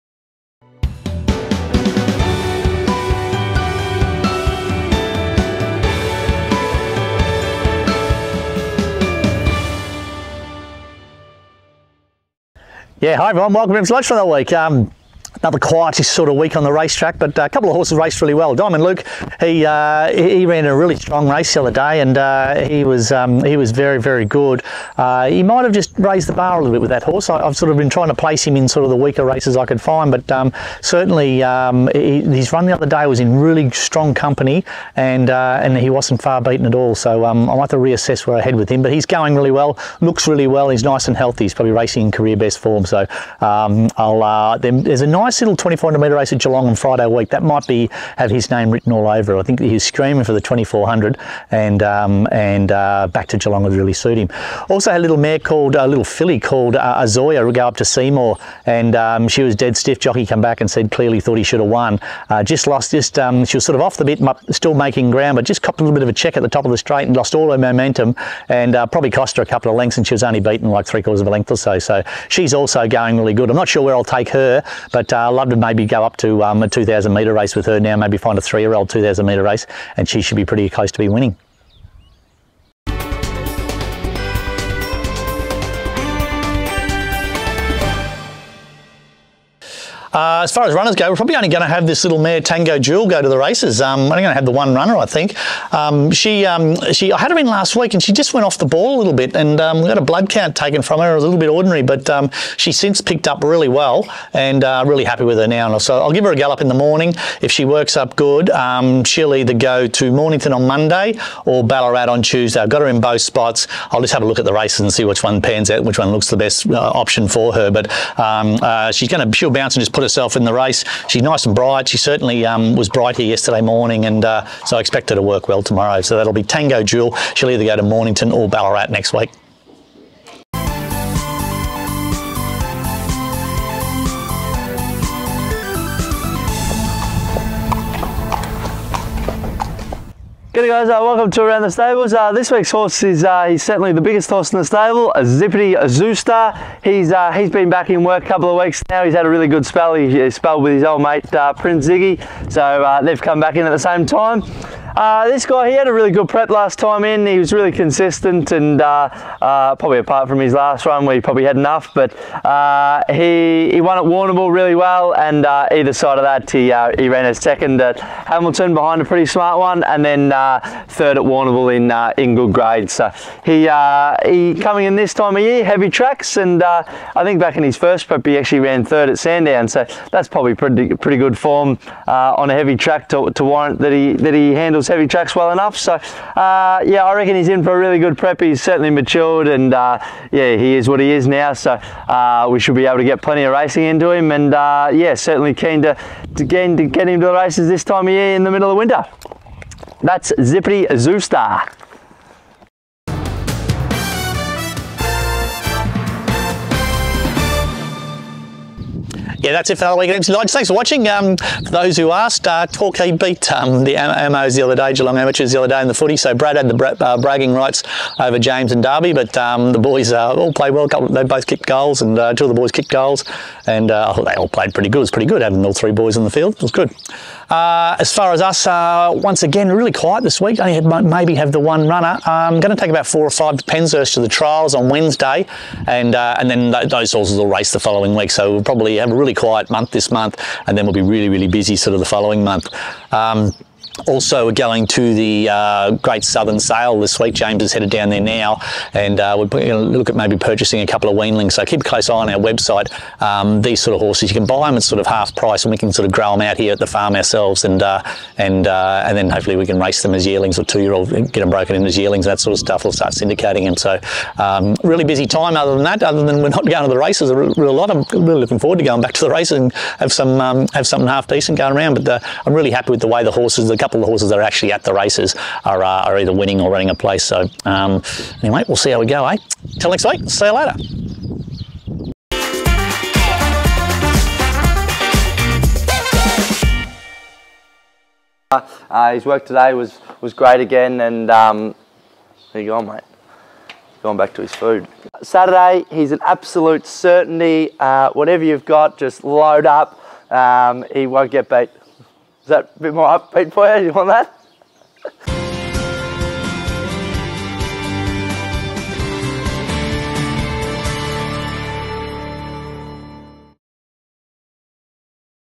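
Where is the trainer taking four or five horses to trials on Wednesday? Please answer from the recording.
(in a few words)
Penshurst.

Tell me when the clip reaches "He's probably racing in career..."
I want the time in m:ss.
0:41.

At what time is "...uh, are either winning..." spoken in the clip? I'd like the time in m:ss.
4:35.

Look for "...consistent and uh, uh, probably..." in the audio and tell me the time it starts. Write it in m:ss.
2:37.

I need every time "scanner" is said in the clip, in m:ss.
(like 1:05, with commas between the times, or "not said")
not said.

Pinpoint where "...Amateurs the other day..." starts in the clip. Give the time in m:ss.
3:35.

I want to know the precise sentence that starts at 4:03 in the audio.
Um, also, we're going to the uh, Great Southern Sale this week.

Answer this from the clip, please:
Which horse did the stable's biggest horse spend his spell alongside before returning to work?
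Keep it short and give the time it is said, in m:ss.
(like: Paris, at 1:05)
Prince Ziggy, at 2:31.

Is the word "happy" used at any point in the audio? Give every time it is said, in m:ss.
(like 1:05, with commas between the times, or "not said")
1:45, 4:32.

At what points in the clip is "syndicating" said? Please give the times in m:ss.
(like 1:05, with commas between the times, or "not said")
4:23.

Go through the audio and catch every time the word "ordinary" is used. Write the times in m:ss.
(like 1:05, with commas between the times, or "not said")
1:41.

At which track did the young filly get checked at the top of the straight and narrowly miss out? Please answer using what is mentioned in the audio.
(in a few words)
Seymour.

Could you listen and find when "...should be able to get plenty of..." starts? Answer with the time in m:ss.
3:12.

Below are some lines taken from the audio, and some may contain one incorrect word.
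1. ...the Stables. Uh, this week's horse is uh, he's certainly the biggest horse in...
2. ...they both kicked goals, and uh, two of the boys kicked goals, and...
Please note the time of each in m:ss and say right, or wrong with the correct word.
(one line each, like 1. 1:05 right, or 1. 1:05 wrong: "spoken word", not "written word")
1. 2:21 right
2. 3:41 right.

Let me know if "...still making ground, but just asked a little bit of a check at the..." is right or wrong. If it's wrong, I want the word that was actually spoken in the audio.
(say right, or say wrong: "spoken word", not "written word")
wrong: "copped", not "asked".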